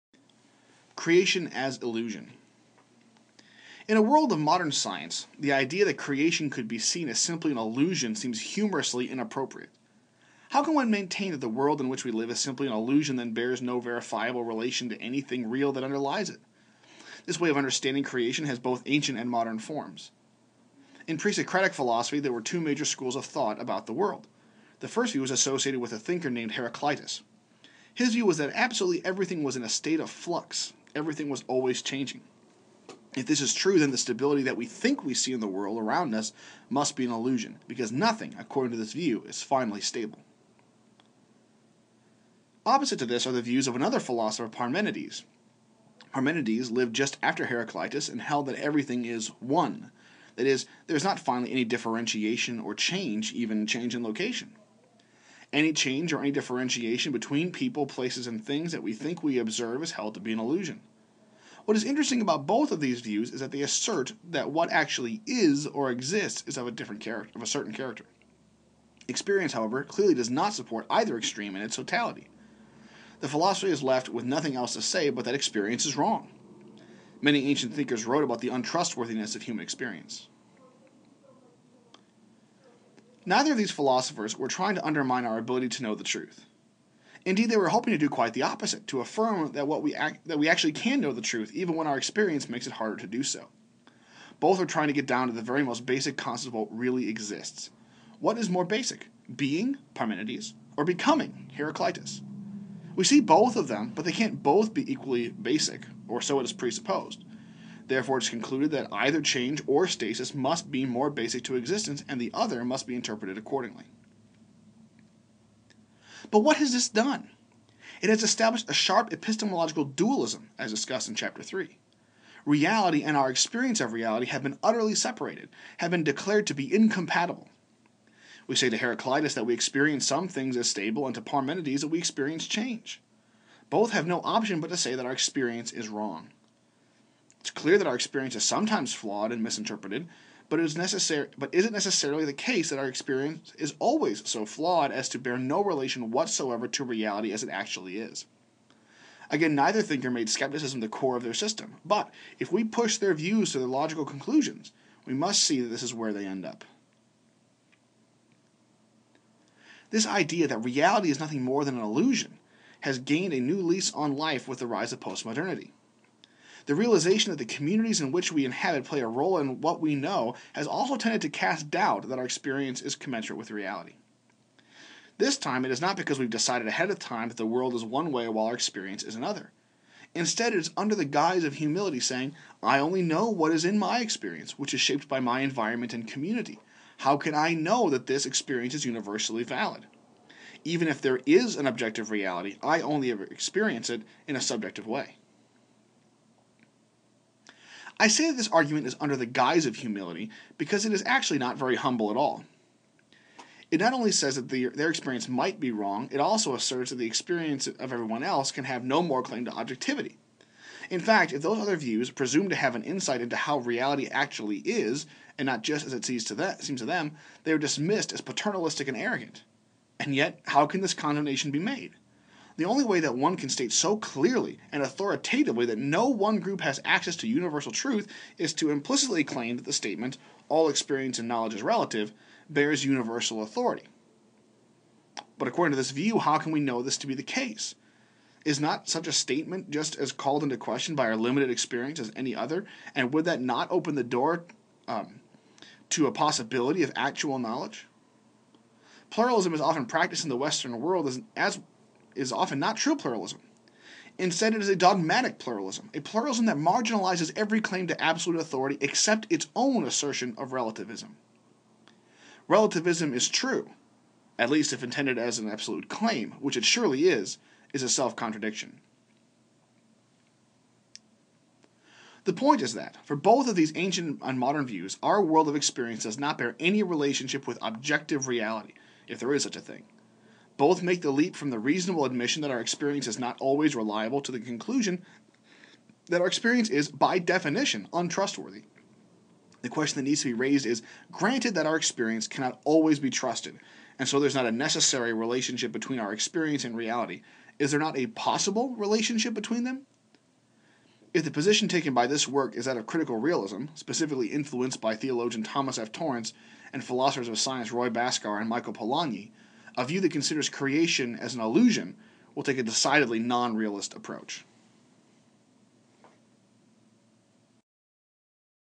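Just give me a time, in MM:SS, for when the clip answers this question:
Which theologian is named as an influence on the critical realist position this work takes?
05:05.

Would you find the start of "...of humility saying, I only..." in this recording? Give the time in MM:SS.
03:01.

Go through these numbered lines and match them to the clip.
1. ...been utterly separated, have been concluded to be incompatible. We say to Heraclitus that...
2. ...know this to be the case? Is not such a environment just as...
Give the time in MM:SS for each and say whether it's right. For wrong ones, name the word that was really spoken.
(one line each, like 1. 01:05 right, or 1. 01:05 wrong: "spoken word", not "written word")
1. 02:04 wrong: "declared", not "concluded"
2. 03:56 wrong: "statement", not "environment".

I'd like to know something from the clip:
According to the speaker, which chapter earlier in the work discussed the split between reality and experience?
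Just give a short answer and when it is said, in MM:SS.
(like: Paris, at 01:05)
Chapter 3, at 02:01.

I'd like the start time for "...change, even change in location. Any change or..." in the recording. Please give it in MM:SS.
00:52.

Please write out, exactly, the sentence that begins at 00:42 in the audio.
Opposite to this are the views of another philosopher, Parmenides.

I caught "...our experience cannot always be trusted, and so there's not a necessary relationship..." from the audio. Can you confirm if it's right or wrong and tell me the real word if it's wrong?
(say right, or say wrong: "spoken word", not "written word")
right.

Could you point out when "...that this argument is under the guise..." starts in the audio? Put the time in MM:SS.
03:18.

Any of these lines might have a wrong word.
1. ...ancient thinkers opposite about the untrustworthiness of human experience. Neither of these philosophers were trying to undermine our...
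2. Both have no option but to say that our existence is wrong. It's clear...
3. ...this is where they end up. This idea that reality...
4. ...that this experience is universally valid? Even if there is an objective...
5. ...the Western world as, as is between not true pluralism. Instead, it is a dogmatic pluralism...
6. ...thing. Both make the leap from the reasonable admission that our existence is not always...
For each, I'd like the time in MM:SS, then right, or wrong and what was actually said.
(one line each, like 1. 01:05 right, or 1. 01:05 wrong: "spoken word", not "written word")
1. 01:17 wrong: "wrote", not "opposite"
2. 02:13 wrong: "experience", not "existence"
3. 02:35 right
4. 03:07 right
5. 04:10 wrong: "often", not "between"
6. 04:39 wrong: "experience", not "existence".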